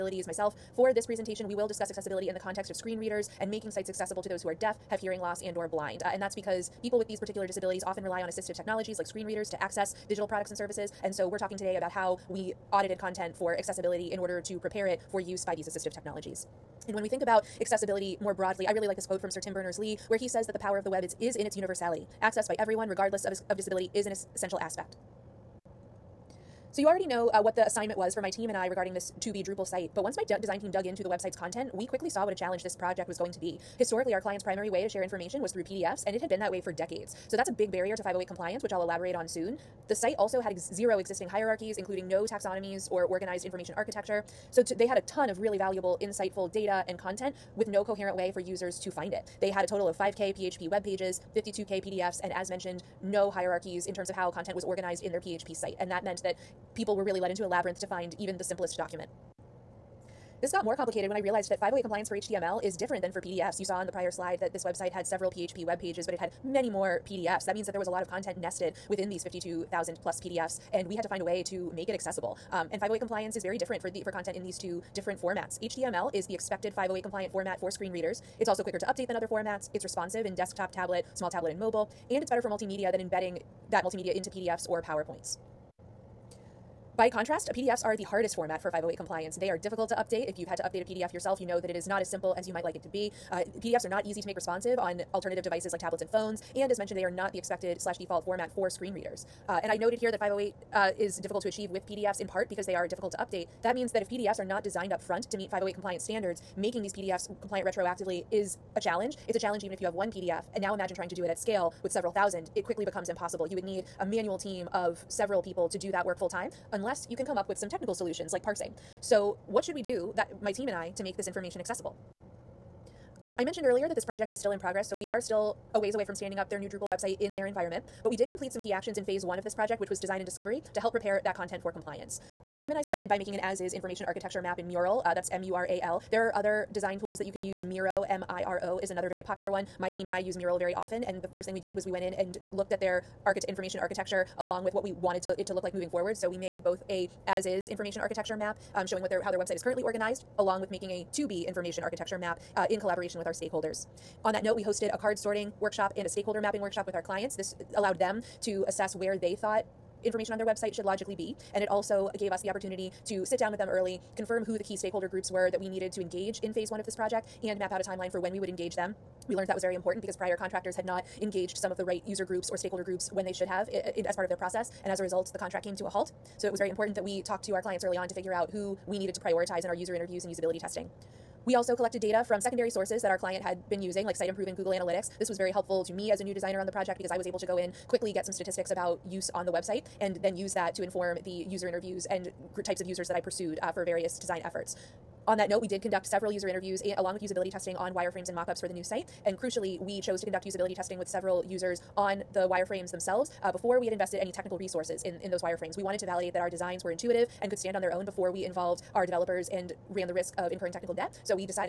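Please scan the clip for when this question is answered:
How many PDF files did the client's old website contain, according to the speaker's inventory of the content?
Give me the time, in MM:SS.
00:51.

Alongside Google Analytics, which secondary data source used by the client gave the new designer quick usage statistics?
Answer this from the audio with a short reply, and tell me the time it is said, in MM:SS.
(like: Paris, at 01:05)
Site Improve, at 03:04.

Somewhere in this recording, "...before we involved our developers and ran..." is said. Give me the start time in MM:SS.
03:28.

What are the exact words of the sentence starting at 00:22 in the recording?
Access by everyone, regardless of, of disability, is an essential aspect.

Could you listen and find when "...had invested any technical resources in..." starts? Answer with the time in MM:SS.
03:23.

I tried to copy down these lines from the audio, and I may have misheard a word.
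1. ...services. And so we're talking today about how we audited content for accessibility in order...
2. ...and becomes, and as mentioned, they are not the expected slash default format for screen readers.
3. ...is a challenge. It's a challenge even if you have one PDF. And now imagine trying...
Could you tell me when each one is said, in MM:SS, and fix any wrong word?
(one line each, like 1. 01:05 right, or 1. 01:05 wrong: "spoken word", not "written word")
1. 00:10 right
2. 01:36 wrong: "phones", not "becomes"
3. 01:48 right.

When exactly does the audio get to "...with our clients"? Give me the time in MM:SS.
02:36.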